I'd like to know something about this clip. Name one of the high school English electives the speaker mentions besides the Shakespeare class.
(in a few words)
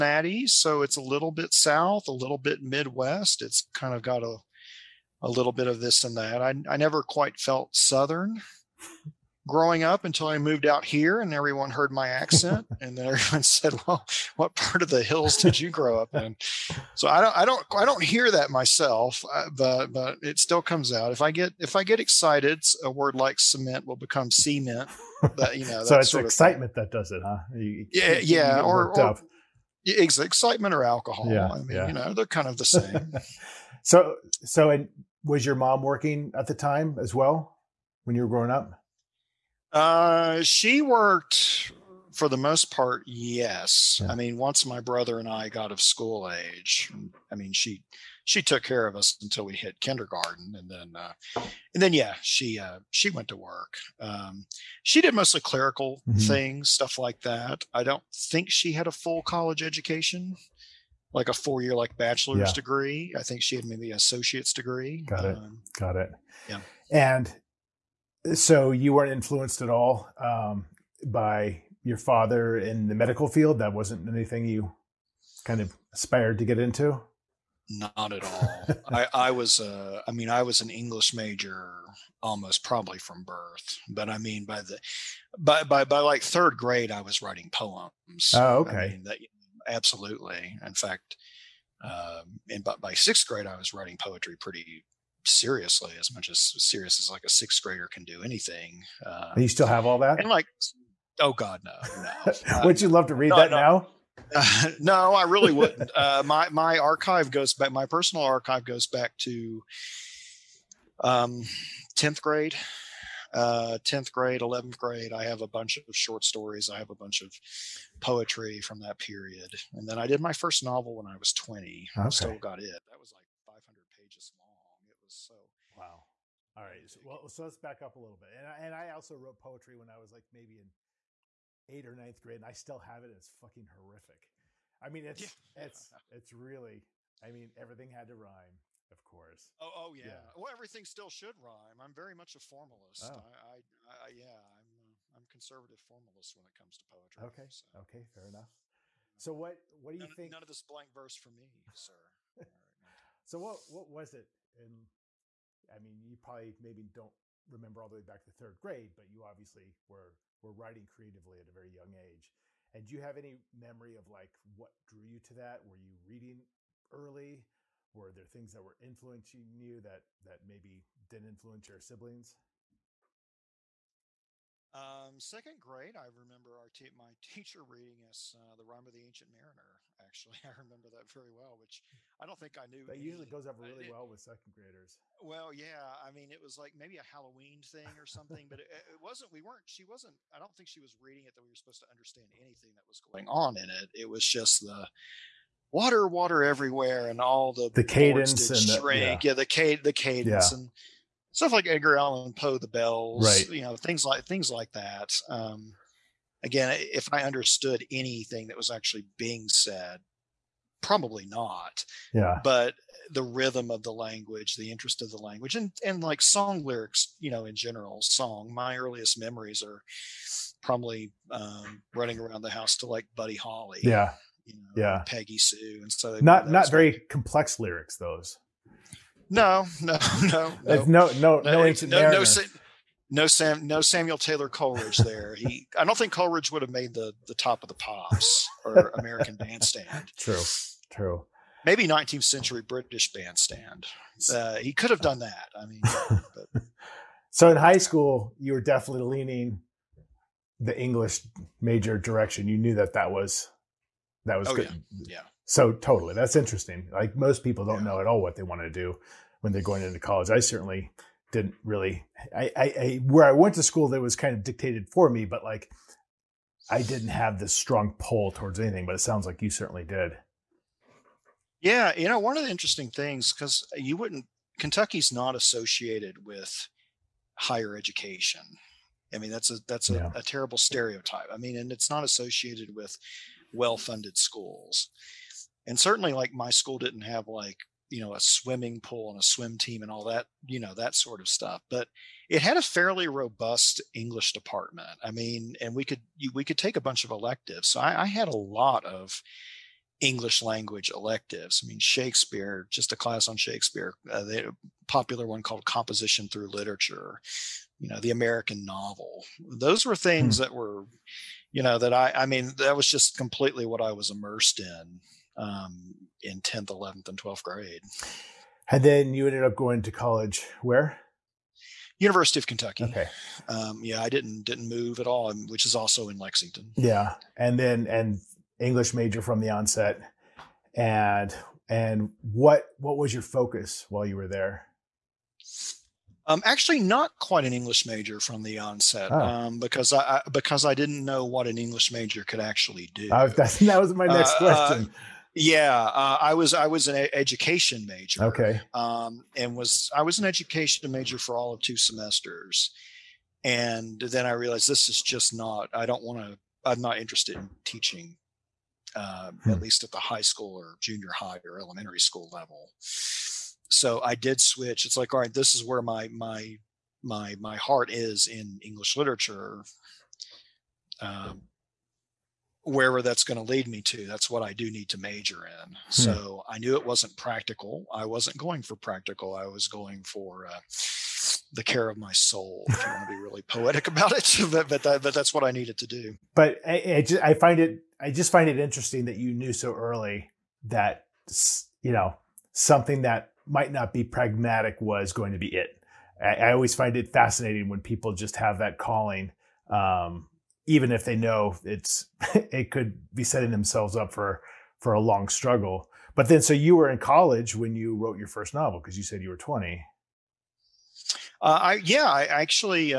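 Composition Through Literature.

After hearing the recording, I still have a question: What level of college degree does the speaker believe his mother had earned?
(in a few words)
Associate's degree.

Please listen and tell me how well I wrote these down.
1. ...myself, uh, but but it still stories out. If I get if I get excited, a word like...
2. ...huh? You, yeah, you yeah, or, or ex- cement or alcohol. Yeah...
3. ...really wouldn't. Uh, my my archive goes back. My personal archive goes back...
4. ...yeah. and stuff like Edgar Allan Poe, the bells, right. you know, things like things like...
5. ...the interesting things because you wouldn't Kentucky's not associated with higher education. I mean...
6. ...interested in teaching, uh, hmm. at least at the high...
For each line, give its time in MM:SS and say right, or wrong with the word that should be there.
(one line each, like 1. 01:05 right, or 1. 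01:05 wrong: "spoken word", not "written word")
1. 00:18 wrong: "comes", not "stories"
2. 00:27 wrong: "excitement", not "cement"
3. 01:45 right
4. 03:20 right
5. 04:32 right
6. 05:56 right.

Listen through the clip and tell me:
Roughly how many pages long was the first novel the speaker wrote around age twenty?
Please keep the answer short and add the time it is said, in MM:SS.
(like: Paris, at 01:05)
500, at 02:03.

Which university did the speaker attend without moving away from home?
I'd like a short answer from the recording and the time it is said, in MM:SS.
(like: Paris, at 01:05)
University of Kentucky, at 05:21.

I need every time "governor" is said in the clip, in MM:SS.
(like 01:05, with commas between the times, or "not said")
not said.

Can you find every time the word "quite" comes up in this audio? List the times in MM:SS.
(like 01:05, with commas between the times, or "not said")
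00:07, 05:37.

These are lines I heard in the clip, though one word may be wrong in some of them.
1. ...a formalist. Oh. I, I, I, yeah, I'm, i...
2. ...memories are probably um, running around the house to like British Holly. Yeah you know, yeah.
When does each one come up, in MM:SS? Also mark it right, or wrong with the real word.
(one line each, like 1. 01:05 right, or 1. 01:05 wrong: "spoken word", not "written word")
1. 02:22 right
2. 03:39 wrong: "Buddy", not "British".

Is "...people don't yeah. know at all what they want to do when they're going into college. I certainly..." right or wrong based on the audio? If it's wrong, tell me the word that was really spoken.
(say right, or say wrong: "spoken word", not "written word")
right.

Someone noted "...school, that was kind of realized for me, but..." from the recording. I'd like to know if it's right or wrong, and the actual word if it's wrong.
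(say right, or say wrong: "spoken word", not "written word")
wrong: "dictated", not "realized".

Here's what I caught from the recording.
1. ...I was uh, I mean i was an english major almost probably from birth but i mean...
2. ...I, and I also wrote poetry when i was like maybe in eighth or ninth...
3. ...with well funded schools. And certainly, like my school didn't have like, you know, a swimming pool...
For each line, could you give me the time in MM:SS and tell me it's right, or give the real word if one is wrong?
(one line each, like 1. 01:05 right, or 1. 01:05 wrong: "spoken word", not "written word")
1. 01:19 right
2. 02:08 right
3. 04:42 right.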